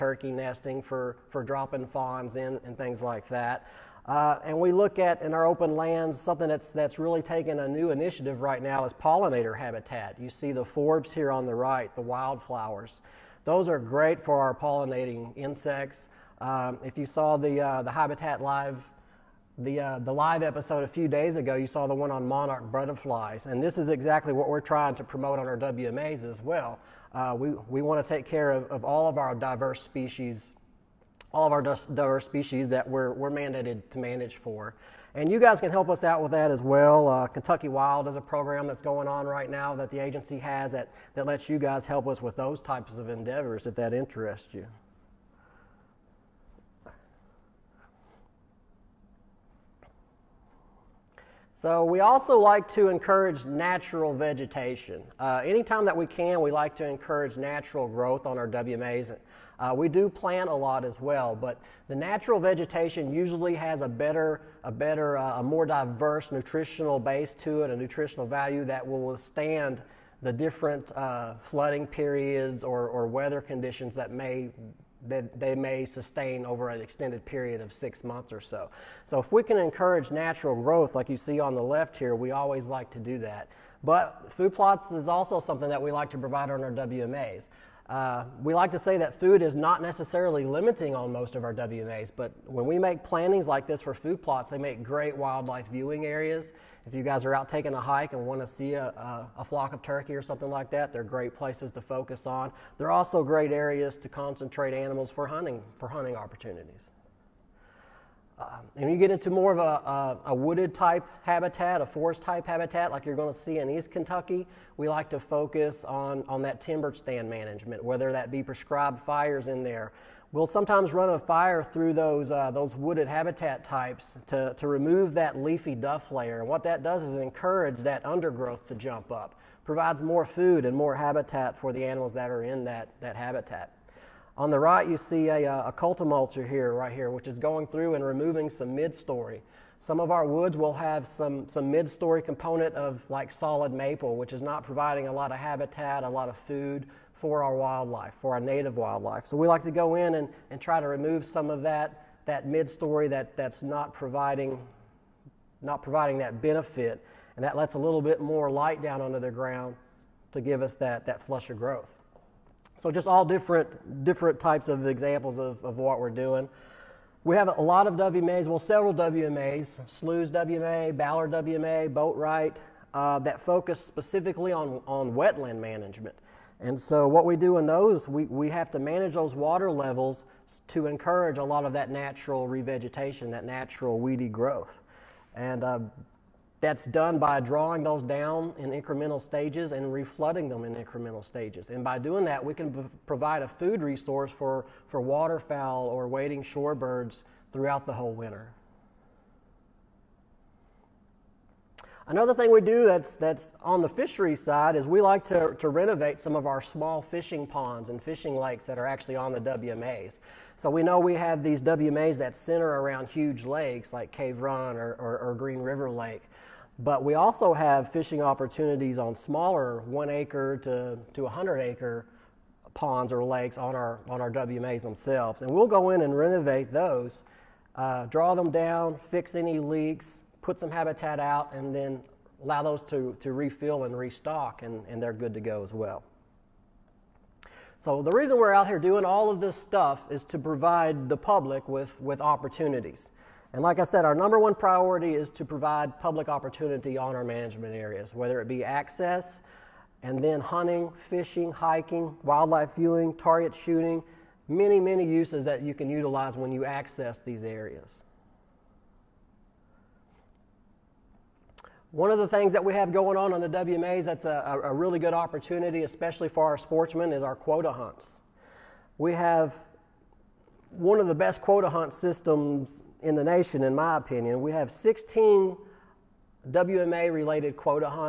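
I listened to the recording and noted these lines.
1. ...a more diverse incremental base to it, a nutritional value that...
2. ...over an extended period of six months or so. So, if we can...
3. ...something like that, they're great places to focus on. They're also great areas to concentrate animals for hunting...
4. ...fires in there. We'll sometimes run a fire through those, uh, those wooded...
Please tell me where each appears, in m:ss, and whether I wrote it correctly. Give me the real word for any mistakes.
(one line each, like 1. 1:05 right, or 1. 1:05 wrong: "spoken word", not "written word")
1. 1:05 wrong: "nutritional", not "incremental"
2. 1:16 right
3. 1:40 right
4. 1:59 right.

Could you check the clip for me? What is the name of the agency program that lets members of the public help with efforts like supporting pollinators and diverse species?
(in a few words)
Kentucky Wild.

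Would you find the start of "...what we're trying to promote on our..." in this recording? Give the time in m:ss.
0:24.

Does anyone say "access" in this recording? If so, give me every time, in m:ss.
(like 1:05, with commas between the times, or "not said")
4:08, 4:16.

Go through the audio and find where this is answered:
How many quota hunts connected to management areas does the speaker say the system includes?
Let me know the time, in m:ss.
4:34.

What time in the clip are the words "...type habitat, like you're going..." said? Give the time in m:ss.
1:52.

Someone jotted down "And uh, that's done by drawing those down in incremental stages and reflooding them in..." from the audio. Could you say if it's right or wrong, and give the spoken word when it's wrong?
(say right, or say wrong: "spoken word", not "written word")
right.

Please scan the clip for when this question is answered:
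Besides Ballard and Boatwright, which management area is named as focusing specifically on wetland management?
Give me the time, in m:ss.
2:49.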